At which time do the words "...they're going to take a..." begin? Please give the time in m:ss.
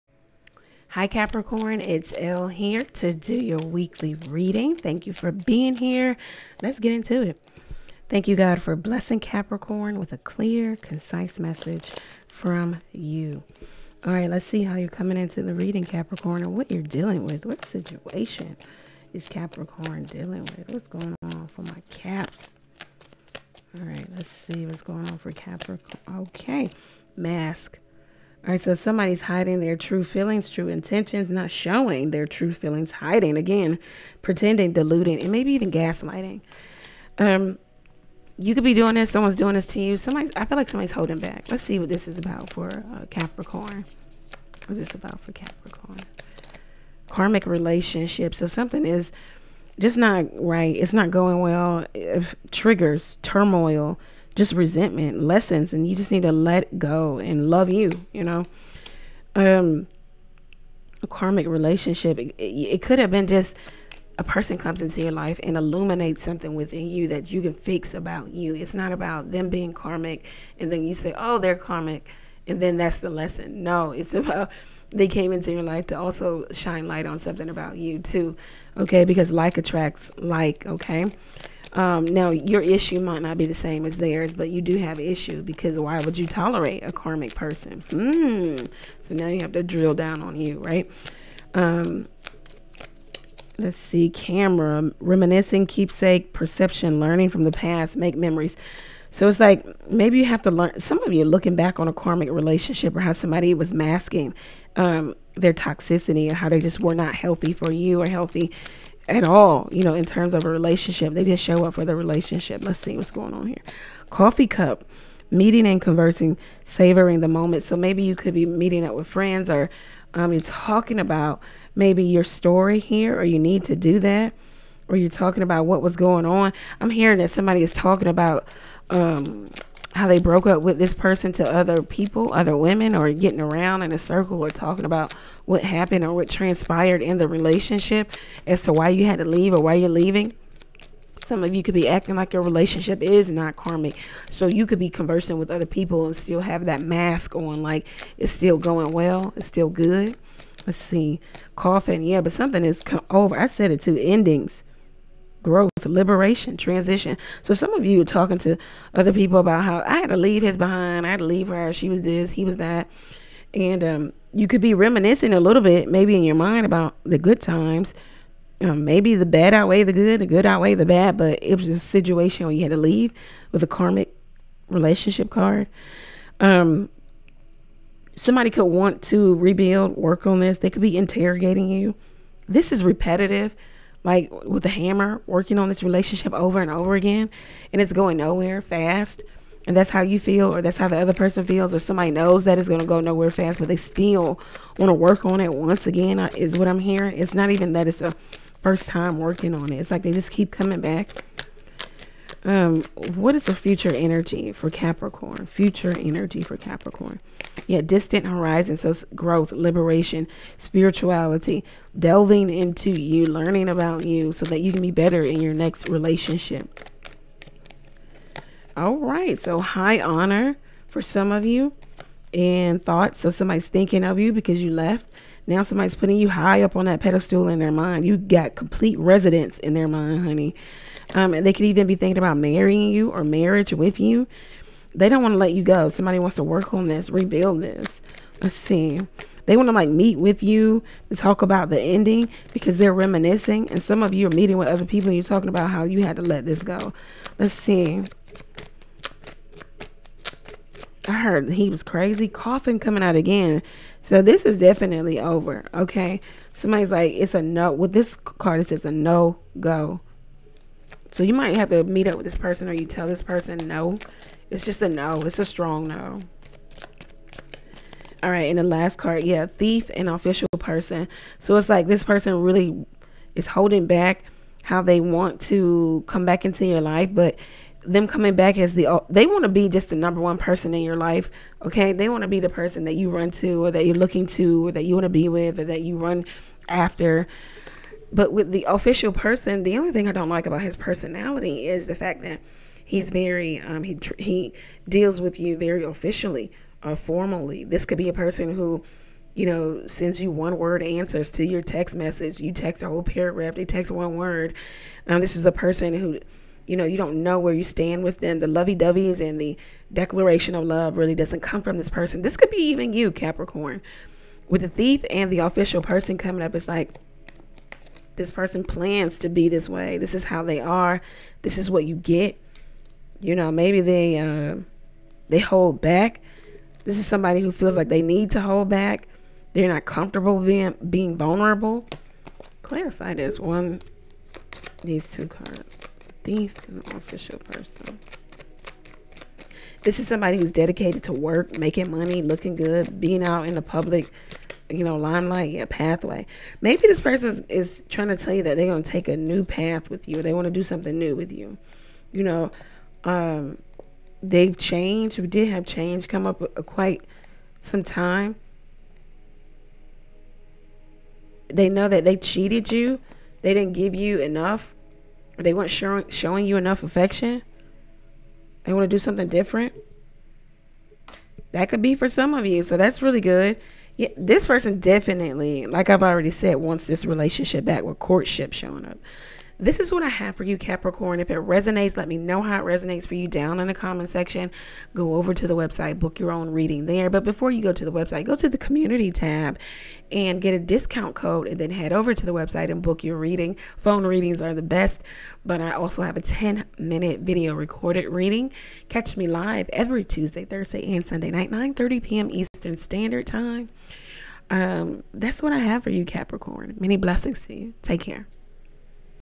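5:48.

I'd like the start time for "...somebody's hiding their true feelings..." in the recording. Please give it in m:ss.
0:28.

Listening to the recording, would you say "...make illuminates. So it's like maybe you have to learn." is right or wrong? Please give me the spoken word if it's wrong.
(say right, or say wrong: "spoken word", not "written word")
wrong: "memories", not "illuminates".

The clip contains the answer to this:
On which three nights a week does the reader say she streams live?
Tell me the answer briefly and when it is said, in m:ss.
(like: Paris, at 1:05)
Tuesday, Thursday, and Sunday, at 6:40.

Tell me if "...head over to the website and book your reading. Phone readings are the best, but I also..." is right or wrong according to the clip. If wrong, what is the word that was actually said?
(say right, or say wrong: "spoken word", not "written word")
right.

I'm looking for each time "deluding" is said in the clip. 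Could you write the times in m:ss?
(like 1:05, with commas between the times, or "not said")
0:34.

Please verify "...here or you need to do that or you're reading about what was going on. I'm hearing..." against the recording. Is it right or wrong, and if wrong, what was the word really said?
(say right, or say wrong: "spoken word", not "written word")
wrong: "talking", not "reading".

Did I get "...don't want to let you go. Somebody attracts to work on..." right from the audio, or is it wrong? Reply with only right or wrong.
wrong.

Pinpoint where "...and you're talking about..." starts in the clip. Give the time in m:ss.
4:05.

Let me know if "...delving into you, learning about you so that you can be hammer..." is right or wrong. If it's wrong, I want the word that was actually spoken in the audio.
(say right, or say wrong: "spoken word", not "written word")
wrong: "better", not "hammer".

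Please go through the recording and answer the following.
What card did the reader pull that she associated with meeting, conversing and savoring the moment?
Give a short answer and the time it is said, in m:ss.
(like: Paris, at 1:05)
Coffee cup, at 1:54.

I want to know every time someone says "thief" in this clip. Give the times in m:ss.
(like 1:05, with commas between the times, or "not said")
4:29, 5:14, 5:36.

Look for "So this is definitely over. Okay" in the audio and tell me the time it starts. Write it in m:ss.
4:14.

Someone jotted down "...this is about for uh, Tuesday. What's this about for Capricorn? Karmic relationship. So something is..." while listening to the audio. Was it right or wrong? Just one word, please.
wrong.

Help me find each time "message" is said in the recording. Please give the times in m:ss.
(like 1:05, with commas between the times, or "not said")
0:11, 5:01.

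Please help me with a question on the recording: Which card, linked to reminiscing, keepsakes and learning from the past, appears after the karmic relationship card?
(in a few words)
Camera.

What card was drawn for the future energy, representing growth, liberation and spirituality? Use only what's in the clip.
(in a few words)
Distant horizons.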